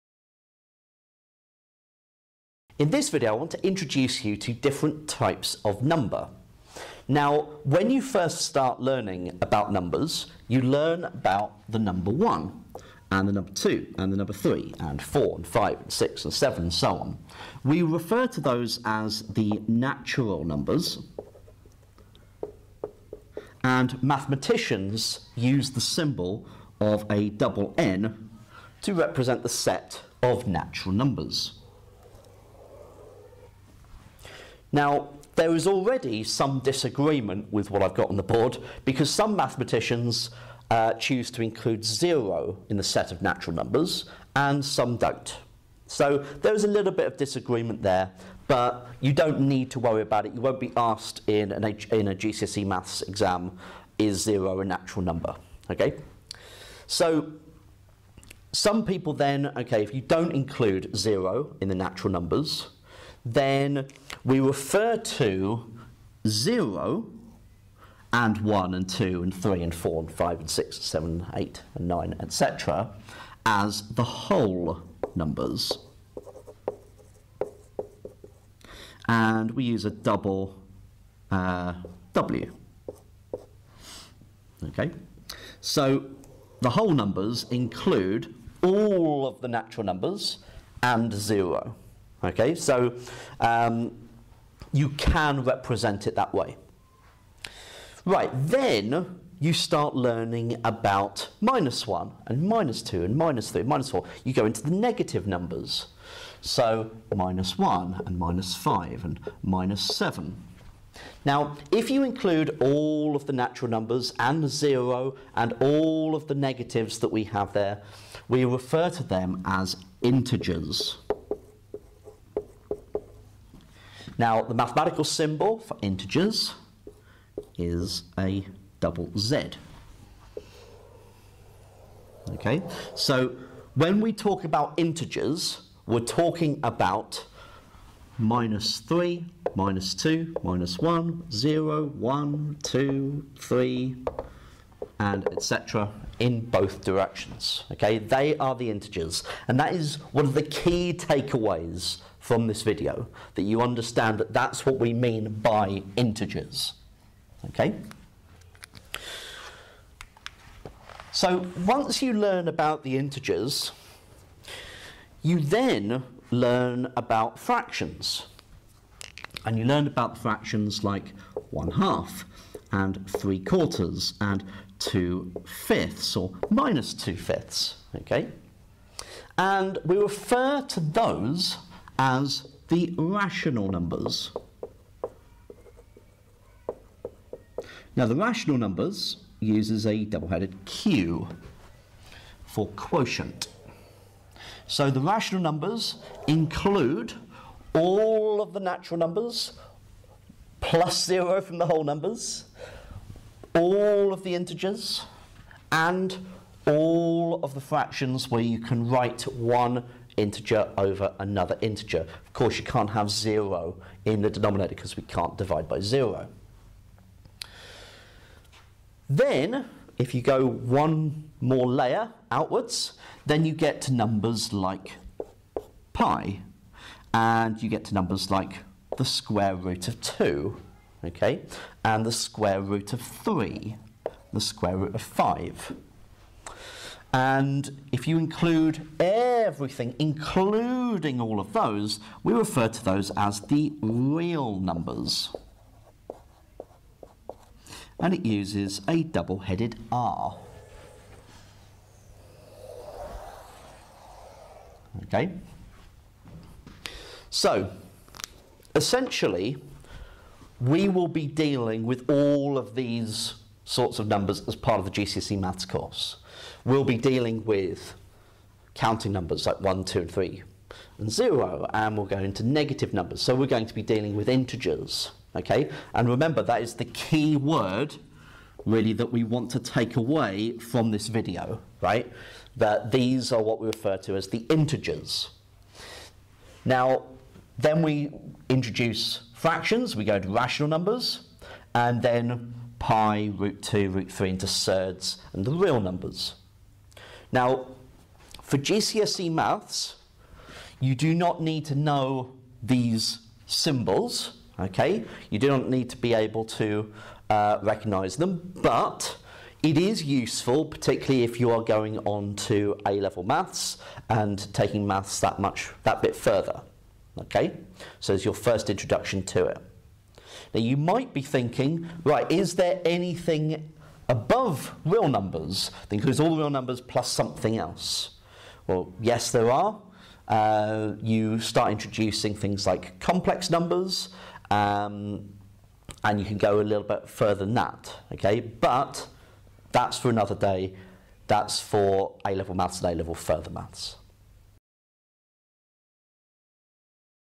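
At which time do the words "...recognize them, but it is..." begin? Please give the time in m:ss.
5:07.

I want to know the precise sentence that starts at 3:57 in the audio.
And if you include everything, including all of those, we refer to those as the real numbers.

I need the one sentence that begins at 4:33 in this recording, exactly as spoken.
So we're going to be dealing with integers.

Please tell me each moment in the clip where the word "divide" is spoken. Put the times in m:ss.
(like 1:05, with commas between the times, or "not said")
3:35.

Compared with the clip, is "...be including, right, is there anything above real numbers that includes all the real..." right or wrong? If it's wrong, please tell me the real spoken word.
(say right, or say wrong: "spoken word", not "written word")
wrong: "thinking", not "including".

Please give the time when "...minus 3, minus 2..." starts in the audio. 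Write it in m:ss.
2:18.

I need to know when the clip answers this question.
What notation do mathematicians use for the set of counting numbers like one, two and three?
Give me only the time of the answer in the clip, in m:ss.
0:27.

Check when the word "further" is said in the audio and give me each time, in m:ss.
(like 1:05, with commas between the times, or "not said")
5:16, 5:37, 5:43.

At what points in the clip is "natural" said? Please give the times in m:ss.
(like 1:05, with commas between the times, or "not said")
0:19, 0:30, 0:43, 0:54, 1:01, 1:29, 1:53, 3:18.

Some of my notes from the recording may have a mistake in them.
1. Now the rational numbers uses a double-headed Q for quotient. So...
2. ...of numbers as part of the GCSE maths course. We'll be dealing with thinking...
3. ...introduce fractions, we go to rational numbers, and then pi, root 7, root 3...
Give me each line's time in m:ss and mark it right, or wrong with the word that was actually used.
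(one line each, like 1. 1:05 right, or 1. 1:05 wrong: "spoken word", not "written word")
1. 3:07 right
2. 4:23 wrong: "counting", not "thinking"
3. 4:48 wrong: "2", not "7".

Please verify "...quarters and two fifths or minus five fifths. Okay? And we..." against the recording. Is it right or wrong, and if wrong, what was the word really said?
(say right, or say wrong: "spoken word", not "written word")
wrong: "two", not "five".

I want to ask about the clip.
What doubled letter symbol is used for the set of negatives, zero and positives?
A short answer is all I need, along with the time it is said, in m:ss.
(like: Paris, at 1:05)
double Z, at 2:08.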